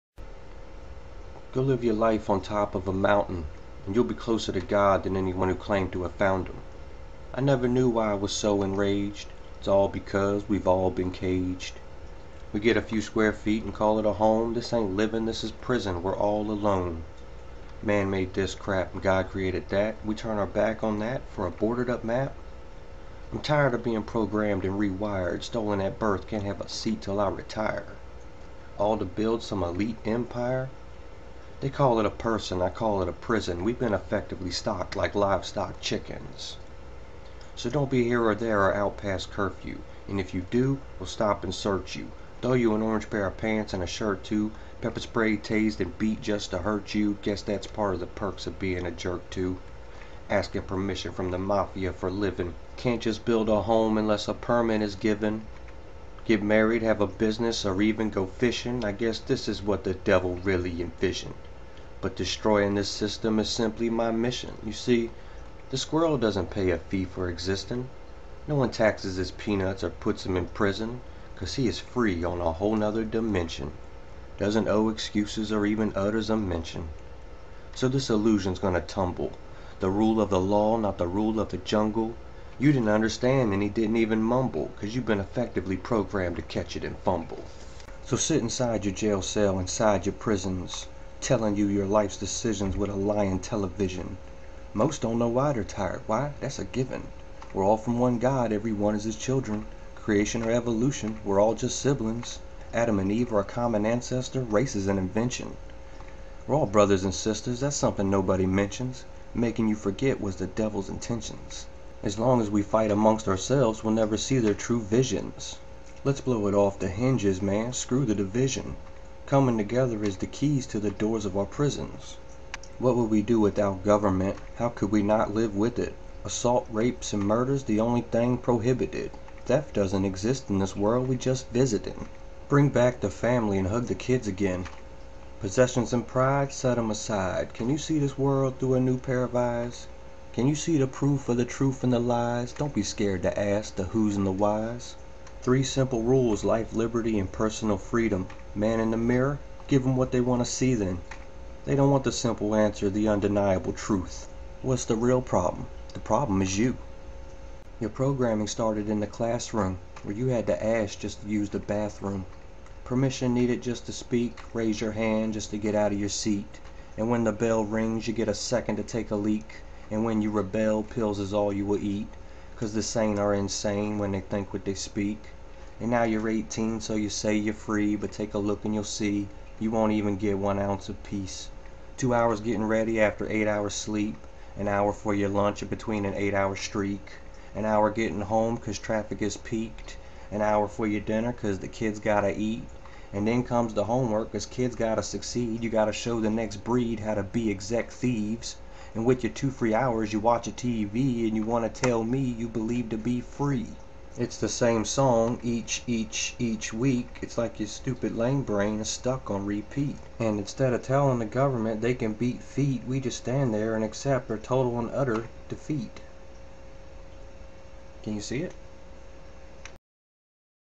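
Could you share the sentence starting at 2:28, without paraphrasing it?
Man in the mirror, give 'em what they want to see then.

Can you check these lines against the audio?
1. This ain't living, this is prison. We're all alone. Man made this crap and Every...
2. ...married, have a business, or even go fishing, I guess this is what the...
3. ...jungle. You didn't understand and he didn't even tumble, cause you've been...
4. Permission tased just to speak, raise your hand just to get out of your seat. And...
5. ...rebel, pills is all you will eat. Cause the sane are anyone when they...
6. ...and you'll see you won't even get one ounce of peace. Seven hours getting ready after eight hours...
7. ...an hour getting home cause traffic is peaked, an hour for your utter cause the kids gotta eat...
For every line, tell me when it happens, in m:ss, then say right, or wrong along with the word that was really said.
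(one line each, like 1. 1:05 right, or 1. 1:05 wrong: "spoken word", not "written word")
1. 0:14 wrong: "God", not "Every"
2. 0:56 right
3. 1:21 wrong: "mumble", not "tumble"
4. 2:42 wrong: "needed", not "tased"
5. 2:50 wrong: "insane", not "anyone"
6. 2:58 wrong: "Two", not "Seven"
7. 3:07 wrong: "dinner", not "utter".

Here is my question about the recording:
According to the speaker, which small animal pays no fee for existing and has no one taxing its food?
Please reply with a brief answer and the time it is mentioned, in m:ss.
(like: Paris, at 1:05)
squirrel, at 1:05.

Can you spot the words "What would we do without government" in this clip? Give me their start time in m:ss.
2:02.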